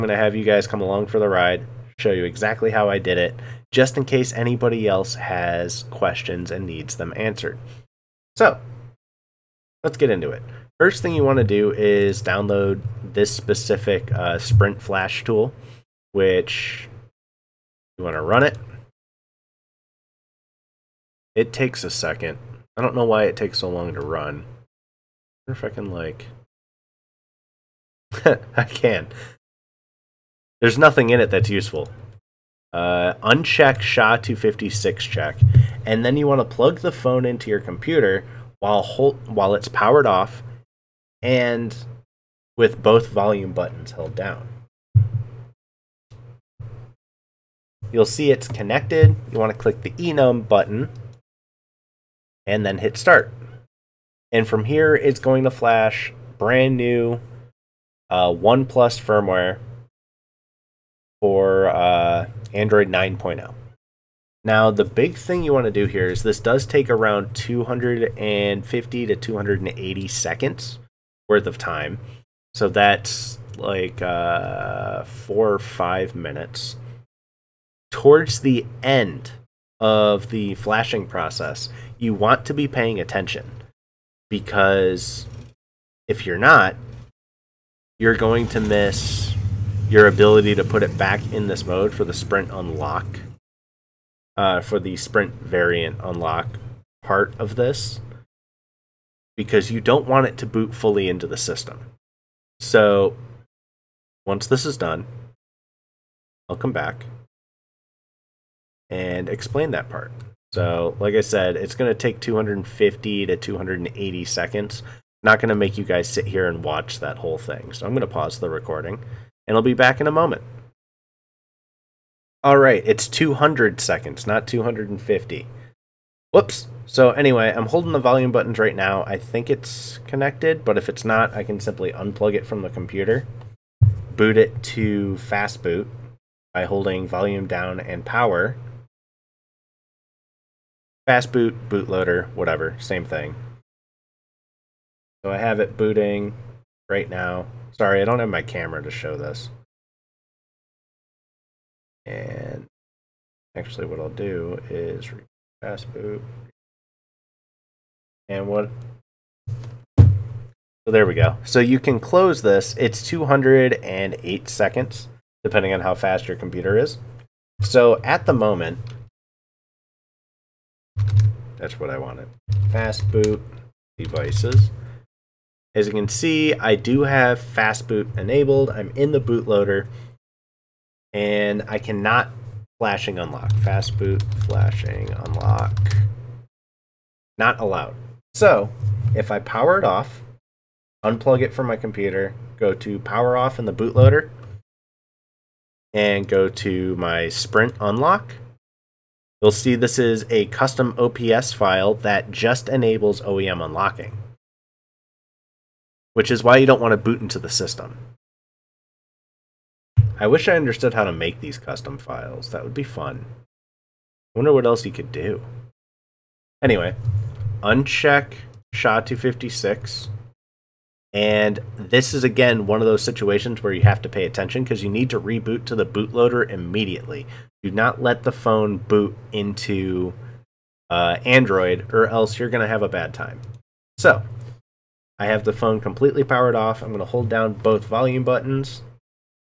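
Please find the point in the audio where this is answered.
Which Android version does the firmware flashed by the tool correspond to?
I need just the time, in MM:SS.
01:02.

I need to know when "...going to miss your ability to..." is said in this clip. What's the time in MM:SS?
01:28.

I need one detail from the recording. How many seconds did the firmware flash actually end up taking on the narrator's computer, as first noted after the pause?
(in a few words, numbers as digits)
200 seconds.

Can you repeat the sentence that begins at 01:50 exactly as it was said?
So, like I said, it's going to take 250 to 280 seconds.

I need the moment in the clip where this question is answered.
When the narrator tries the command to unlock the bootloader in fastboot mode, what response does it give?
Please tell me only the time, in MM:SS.
03:07.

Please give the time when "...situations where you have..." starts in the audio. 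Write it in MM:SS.
03:43.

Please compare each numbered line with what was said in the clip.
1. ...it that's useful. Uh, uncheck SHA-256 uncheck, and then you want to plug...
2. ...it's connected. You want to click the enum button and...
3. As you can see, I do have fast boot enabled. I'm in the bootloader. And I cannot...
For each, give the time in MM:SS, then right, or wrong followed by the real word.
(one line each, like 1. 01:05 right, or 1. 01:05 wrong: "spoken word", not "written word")
1. 00:31 wrong: "check", not "uncheck"
2. 00:48 right
3. 02:55 right.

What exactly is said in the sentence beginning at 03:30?
I wish I understood how to make these custom files.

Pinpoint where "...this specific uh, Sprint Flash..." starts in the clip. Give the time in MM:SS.
00:13.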